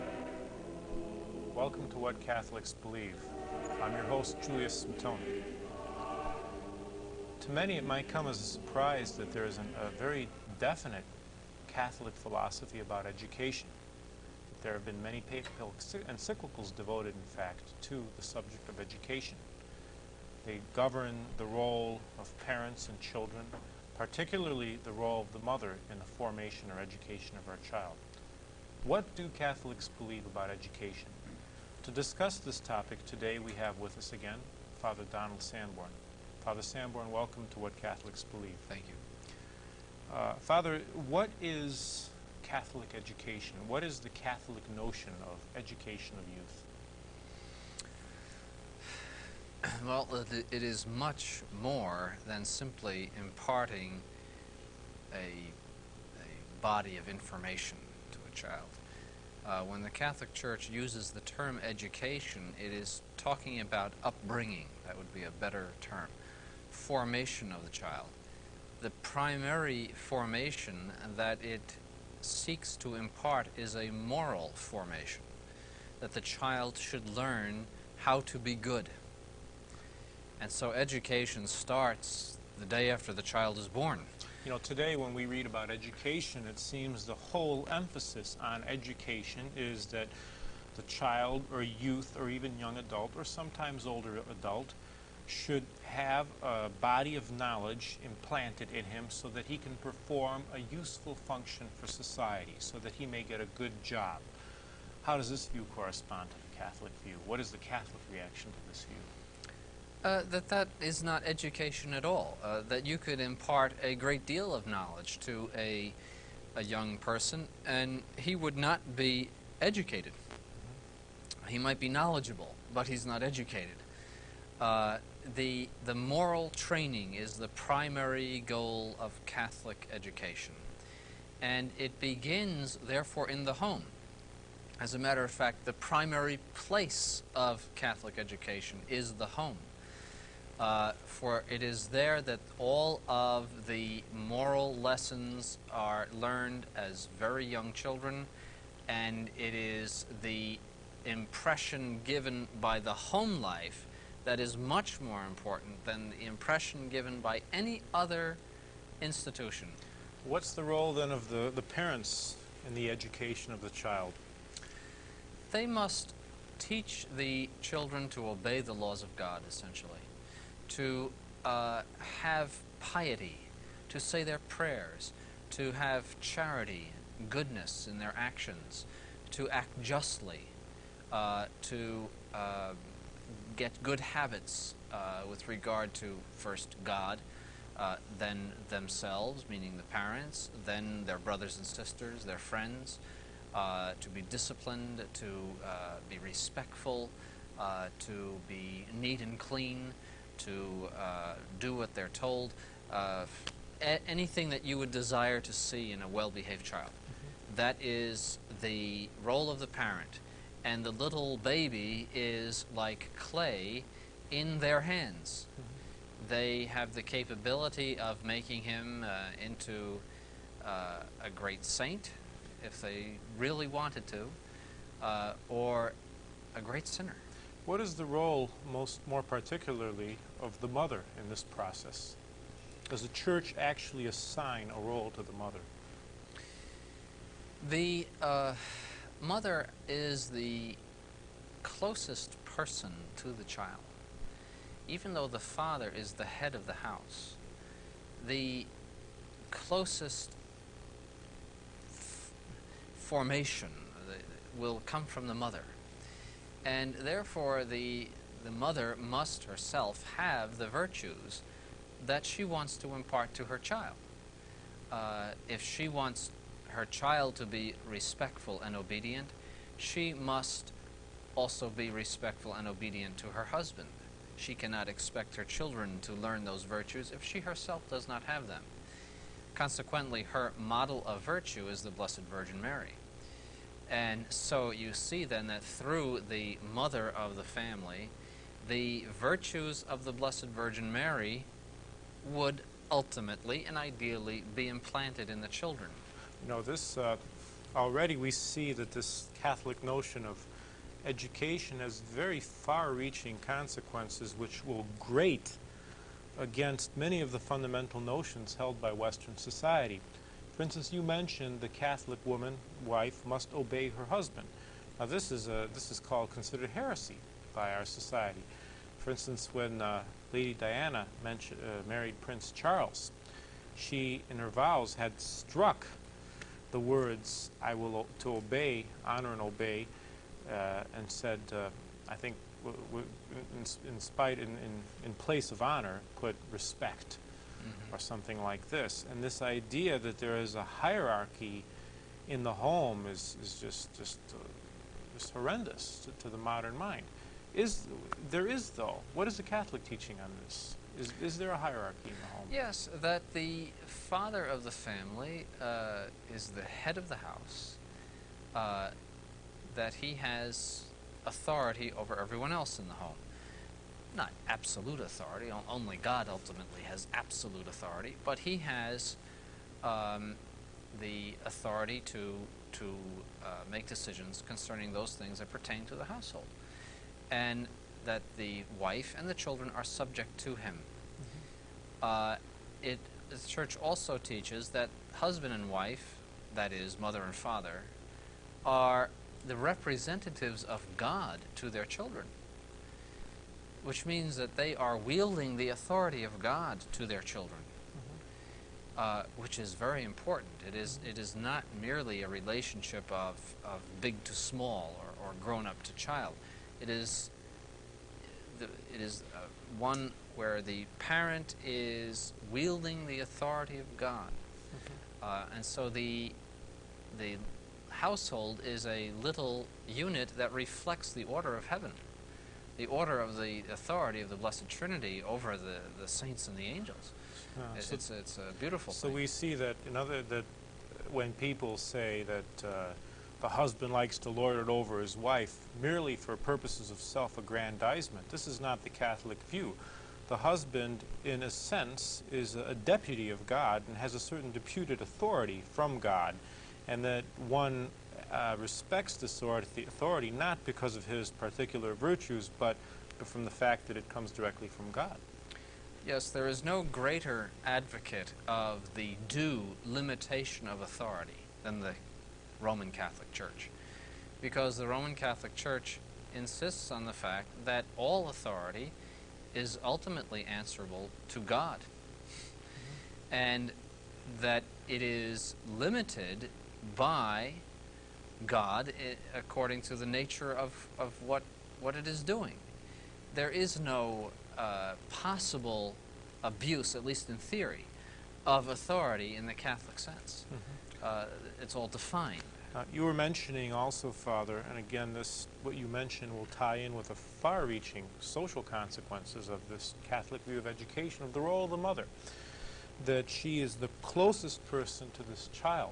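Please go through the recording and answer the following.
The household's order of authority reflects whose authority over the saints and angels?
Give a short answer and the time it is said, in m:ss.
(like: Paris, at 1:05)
the Blessed Trinity, at 7:04.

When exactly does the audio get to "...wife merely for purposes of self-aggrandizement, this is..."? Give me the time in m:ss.
7:15.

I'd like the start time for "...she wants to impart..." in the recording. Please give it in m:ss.
4:22.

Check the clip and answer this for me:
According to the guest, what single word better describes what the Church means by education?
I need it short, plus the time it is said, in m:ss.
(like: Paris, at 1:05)
upbringing, at 1:04.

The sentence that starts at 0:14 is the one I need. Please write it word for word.
There have been many papal encyclicals devoted, in fact, to the subject of education.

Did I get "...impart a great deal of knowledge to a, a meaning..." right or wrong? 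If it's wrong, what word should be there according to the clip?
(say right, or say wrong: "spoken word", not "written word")
wrong: "young", not "meaning".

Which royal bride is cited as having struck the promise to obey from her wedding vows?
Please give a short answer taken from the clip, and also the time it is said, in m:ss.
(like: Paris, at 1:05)
Lady Diana, at 5:20.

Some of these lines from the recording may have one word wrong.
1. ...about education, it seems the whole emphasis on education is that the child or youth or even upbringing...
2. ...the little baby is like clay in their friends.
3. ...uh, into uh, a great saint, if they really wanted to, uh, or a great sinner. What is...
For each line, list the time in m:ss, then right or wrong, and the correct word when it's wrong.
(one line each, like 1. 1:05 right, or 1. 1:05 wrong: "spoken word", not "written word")
1. 1:25 wrong: "young", not "upbringing"
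2. 3:30 wrong: "hands", not "friends"
3. 3:39 right.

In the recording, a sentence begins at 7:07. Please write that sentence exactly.
Uh, it's, so it's, it's, a beautiful so thing.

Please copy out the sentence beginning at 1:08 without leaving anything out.
The primary formation that it seeks to impart is a moral formation, that the child should learn how to be good.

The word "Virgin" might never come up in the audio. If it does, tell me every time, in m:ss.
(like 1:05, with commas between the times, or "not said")
4:42, 4:50.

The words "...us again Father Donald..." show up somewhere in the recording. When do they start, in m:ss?
0:33.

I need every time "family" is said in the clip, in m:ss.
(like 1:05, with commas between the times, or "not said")
4:47, 5:54.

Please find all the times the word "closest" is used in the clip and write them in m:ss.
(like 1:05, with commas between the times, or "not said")
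4:01, 4:09, 8:24.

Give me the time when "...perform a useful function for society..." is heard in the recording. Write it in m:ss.
1:39.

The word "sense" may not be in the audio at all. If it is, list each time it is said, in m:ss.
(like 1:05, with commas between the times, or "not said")
7:21, 8:09.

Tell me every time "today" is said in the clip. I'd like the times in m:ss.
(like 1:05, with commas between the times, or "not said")
0:33, 1:24.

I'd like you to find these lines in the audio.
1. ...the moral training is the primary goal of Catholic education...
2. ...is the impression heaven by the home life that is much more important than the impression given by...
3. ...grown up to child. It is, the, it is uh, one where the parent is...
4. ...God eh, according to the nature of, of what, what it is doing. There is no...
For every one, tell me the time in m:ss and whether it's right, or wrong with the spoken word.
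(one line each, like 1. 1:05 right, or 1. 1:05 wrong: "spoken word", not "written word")
1. 2:05 right
2. 2:29 wrong: "given", not "heaven"
3. 6:45 right
4. 7:58 right.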